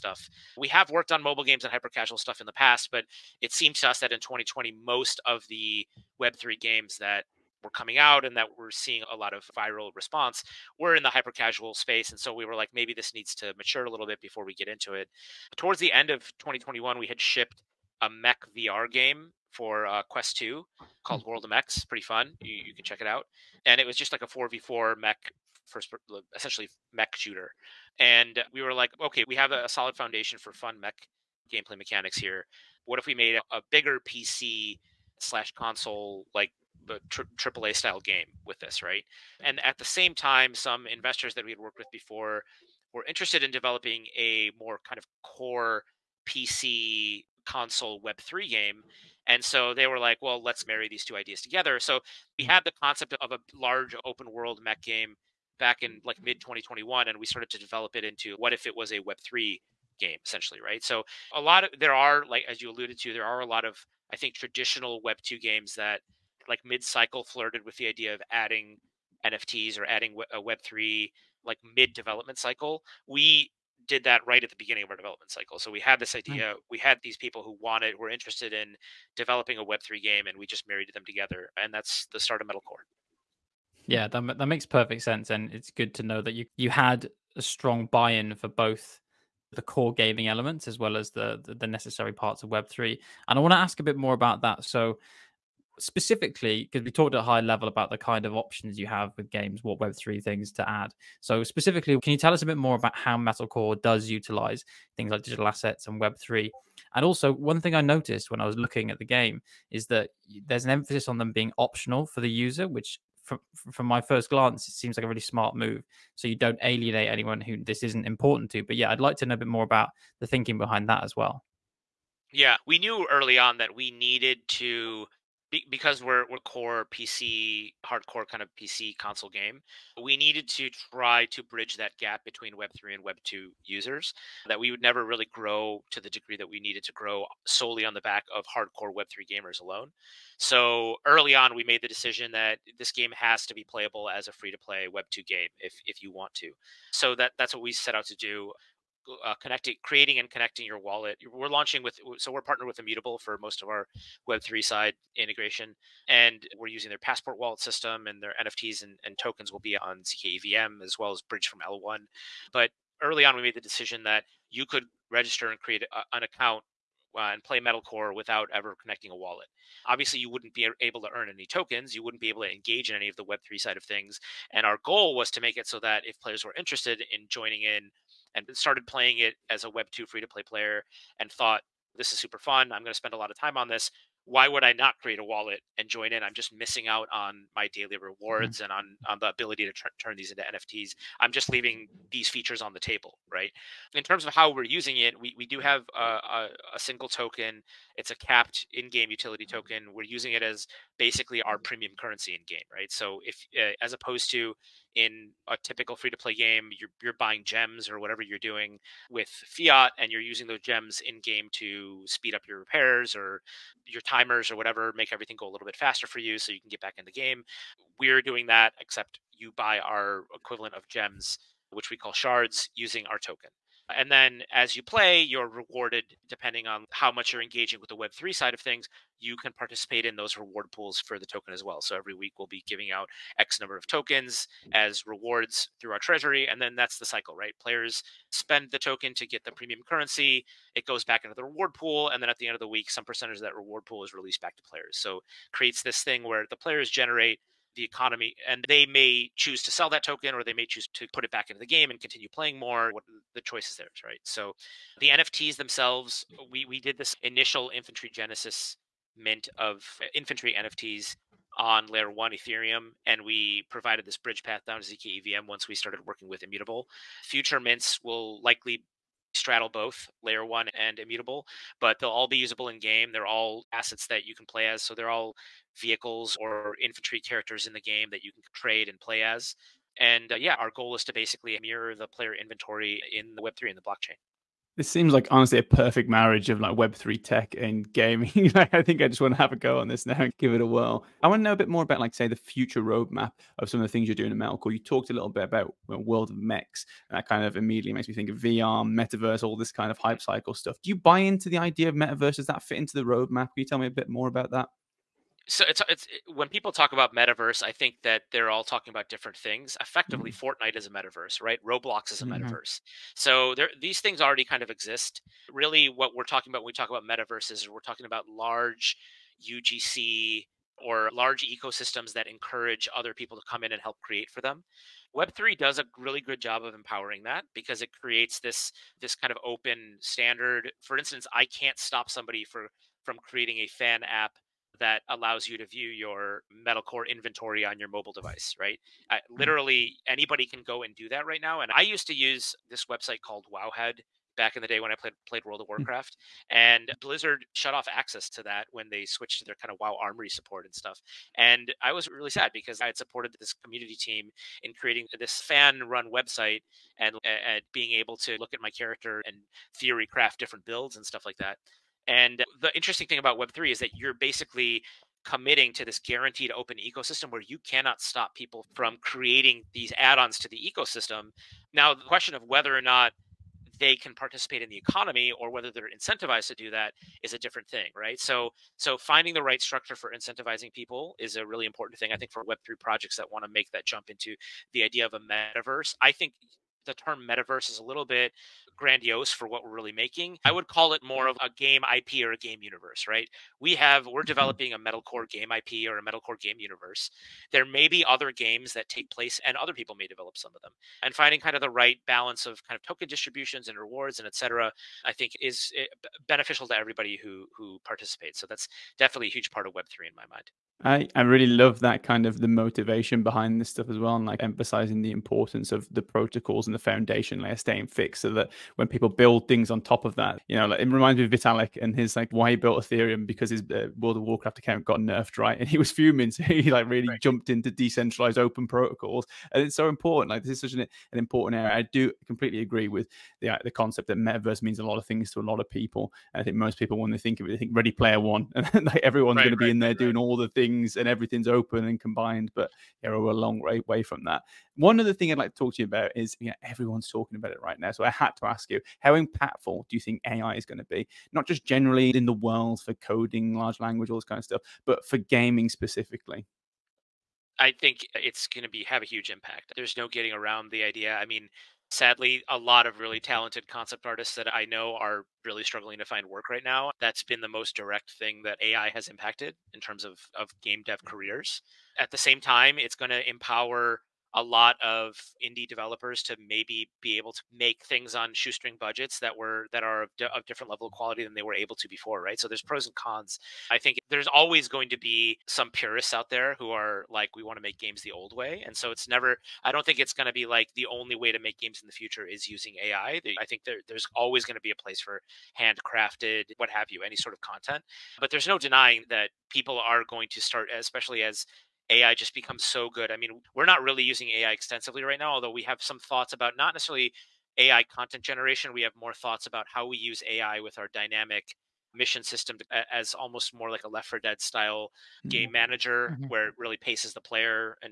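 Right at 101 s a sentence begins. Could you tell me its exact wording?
So specifically, can you tell us a bit more about how Metalcore does utilize things like digital assets and Web3?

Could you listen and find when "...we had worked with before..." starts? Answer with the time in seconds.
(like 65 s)
41 s.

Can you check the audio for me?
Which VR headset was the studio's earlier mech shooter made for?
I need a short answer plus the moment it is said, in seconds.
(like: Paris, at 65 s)
Quest 2, at 20 s.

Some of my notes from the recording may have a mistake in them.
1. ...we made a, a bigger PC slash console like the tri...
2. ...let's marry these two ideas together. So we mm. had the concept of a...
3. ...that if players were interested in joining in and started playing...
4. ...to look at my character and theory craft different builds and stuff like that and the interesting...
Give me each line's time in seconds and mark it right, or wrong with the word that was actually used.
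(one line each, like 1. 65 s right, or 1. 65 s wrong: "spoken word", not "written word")
1. 33 s right
2. 50 s right
3. 175 s right
4. 358 s right.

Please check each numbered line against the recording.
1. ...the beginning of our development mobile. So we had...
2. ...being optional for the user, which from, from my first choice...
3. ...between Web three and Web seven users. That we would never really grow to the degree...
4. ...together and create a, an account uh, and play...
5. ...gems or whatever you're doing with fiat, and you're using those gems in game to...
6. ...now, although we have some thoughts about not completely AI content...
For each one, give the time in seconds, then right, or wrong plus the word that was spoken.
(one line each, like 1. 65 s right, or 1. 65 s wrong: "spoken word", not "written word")
1. 74 s wrong: "cycle", not "mobile"
2. 111 s wrong: "glance", not "choice"
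3. 132 s wrong: "two", not "seven"
4. 165 s wrong: "register", not "together"
5. 207 s right
6. 505 s wrong: "necessarily", not "completely".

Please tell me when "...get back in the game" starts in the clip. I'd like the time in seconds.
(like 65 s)
216 s.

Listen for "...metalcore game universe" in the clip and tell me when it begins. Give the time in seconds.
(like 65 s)
396 s.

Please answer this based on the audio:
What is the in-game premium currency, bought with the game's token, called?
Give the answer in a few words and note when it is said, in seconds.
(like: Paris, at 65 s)
shards, at 222 s.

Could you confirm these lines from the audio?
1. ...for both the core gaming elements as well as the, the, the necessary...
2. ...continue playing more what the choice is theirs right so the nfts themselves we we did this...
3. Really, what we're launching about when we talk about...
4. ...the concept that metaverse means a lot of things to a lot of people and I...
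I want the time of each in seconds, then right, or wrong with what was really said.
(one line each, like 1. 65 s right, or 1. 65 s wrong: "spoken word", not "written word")
1. 88 s right
2. 251 s right
3. 315 s wrong: "talking", not "launching"
4. 433 s right.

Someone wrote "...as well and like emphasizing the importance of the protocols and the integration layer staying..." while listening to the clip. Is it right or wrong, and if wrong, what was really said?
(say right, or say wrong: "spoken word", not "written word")
wrong: "foundation", not "integration".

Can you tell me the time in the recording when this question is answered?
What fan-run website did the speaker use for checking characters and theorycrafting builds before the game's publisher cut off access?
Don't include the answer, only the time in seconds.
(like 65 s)
343 s.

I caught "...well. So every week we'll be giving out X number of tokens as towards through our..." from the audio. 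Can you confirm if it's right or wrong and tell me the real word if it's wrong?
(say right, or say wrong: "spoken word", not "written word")
wrong: "rewards", not "towards".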